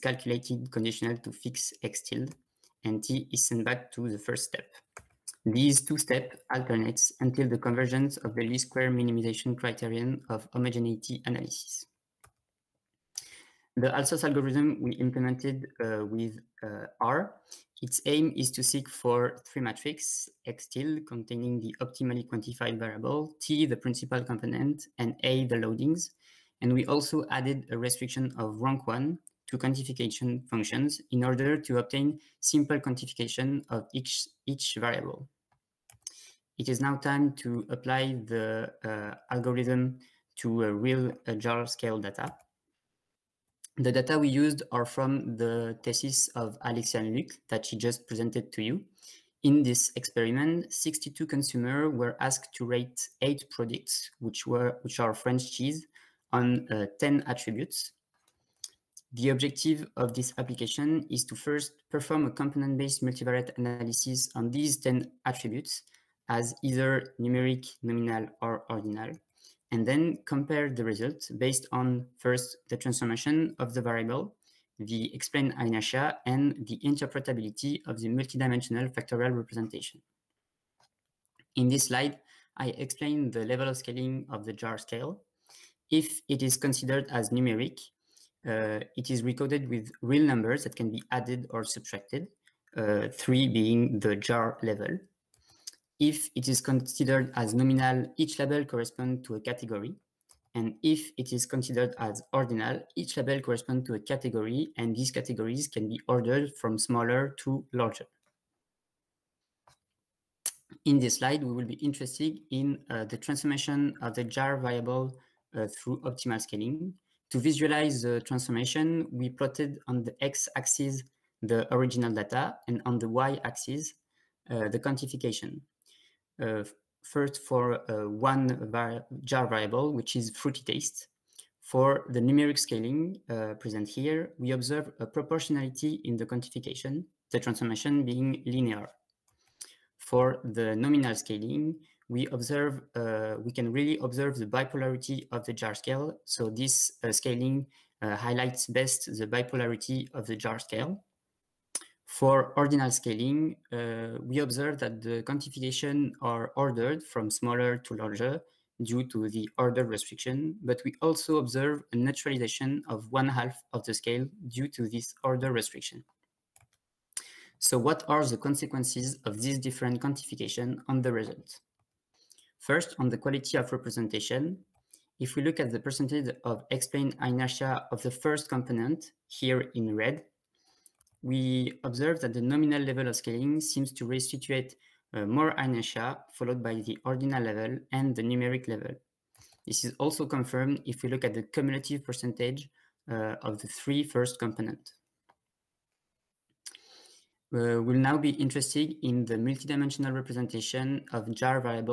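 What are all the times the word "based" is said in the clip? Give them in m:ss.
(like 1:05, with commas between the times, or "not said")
1:02, 1:11.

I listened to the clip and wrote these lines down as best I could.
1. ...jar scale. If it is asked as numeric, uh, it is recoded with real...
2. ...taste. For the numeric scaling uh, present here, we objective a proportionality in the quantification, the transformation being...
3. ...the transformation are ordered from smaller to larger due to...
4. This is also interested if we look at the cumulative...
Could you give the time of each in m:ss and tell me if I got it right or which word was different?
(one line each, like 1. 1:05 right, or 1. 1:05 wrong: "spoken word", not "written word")
1. 1:24 wrong: "considered", not "asked"
2. 2:10 wrong: "observe", not "objective"
3. 2:35 wrong: "quantification", not "transformation"
4. 3:09 wrong: "confirmed", not "interested".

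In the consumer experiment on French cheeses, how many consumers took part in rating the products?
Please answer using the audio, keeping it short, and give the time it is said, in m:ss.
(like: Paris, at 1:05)
62, at 0:50.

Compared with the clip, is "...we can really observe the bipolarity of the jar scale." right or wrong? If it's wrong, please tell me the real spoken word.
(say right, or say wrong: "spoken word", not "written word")
right.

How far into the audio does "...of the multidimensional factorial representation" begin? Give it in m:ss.
1:17.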